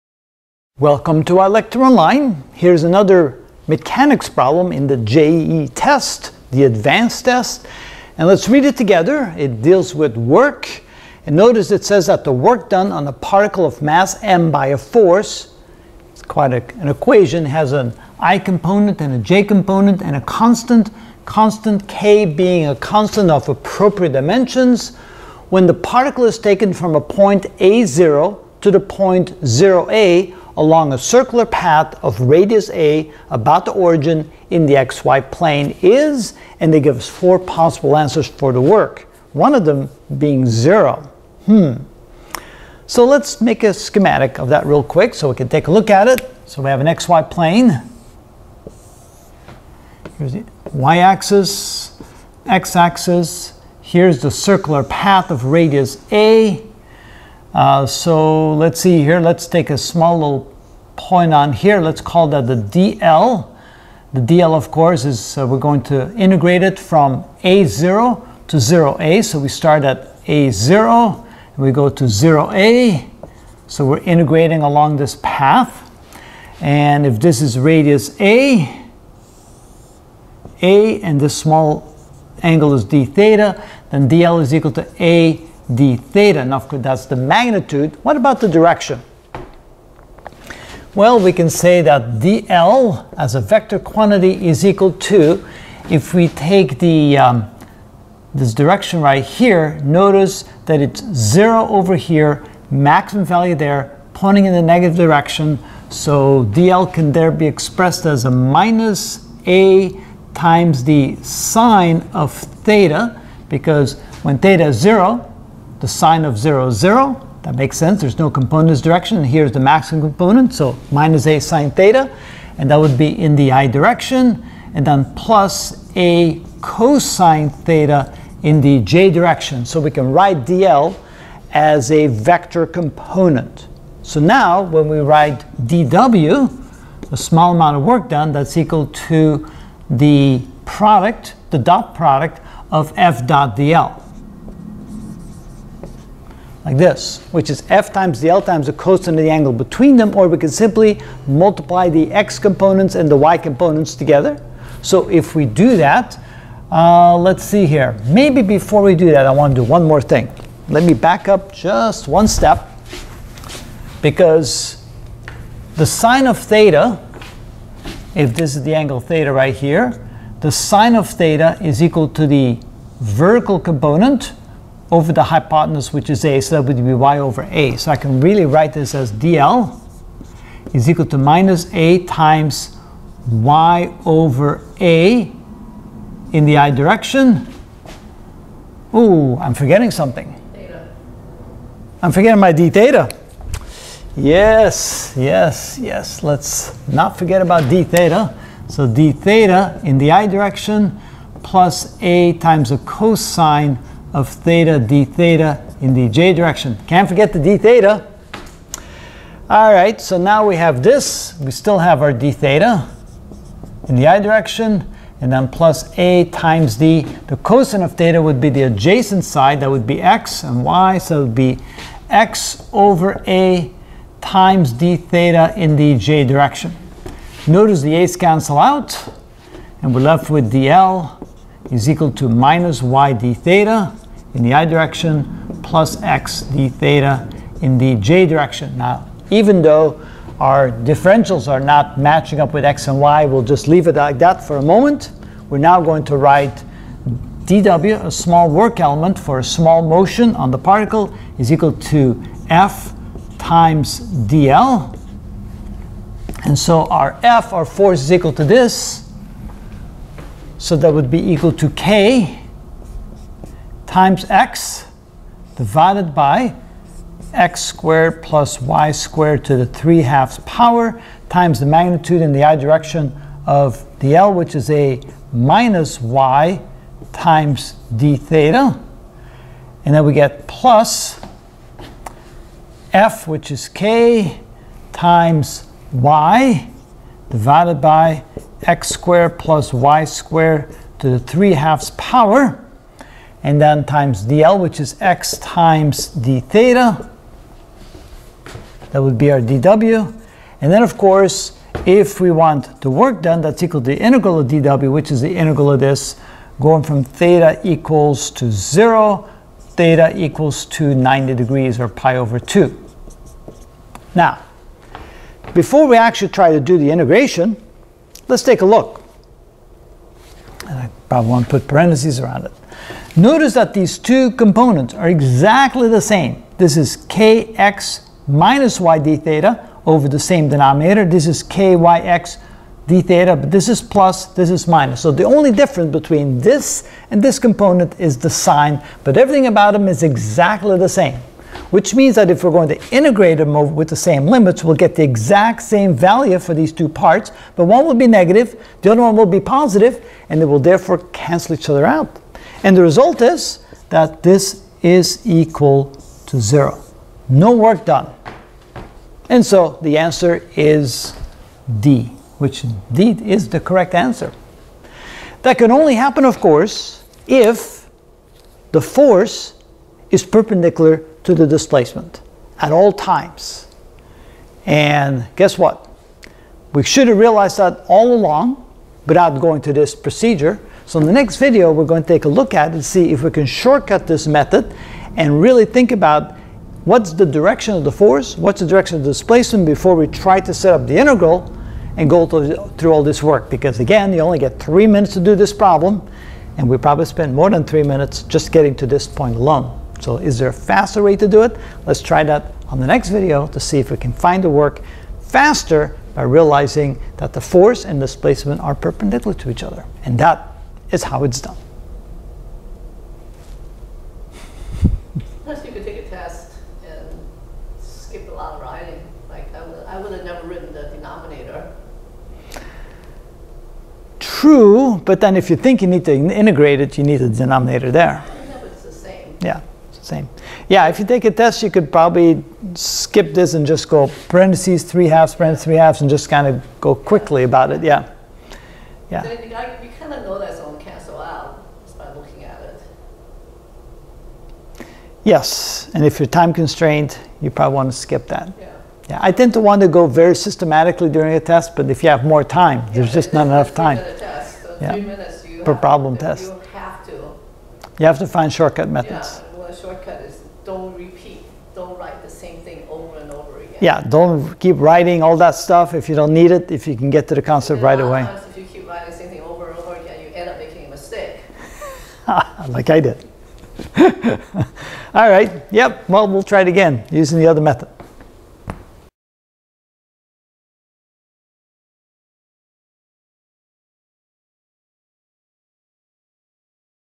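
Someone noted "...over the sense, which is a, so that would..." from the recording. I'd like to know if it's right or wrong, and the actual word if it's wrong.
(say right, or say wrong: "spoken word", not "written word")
wrong: "hypotenuse", not "sense".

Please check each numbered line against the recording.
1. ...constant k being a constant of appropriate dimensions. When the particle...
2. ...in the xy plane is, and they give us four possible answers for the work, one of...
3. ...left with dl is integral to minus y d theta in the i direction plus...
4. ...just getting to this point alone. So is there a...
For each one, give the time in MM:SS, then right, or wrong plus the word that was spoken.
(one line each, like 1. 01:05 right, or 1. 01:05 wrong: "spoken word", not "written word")
1. 00:21 right
2. 00:34 right
3. 03:50 wrong: "equal", not "integral"
4. 06:38 right.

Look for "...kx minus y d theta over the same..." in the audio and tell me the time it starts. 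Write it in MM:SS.
05:27.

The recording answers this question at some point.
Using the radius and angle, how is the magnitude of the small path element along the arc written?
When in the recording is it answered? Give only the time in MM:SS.
01:25.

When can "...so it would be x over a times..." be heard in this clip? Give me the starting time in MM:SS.
03:40.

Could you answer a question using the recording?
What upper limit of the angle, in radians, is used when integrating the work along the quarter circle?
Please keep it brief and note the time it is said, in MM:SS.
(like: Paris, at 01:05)
pi over 2, at 05:11.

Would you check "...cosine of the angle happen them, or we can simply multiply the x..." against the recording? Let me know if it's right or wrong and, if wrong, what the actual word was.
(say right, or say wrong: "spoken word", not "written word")
wrong: "between", not "happen".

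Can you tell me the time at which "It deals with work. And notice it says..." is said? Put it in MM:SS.
00:09.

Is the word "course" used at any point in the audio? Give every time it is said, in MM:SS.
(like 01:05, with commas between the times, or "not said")
01:04, 01:26, 05:00, 06:06.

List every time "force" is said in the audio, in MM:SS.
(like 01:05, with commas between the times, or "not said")
00:14, 04:17, 06:08, 06:27, 06:47.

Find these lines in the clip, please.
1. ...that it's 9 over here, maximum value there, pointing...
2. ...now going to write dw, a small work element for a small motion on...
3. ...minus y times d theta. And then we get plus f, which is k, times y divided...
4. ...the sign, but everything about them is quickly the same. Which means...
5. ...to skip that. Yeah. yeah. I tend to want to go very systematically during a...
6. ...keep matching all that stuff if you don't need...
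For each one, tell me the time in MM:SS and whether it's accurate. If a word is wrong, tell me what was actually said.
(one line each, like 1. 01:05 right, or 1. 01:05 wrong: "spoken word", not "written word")
1. 01:40 wrong: "0", not "9"
2. 04:05 right
3. 04:35 right
4. 05:38 wrong: "exactly", not "quickly"
5. 07:27 right
6. 07:44 wrong: "writing", not "matching".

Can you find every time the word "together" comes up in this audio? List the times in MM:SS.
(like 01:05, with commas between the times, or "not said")
00:08, 02:33.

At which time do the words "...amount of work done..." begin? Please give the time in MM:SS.
02:17.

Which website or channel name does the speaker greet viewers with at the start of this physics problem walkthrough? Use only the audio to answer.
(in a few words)
ilectureonline.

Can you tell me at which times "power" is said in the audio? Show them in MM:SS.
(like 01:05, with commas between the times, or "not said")
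04:30, 04:51.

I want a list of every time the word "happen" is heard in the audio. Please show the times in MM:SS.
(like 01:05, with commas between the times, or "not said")
06:05.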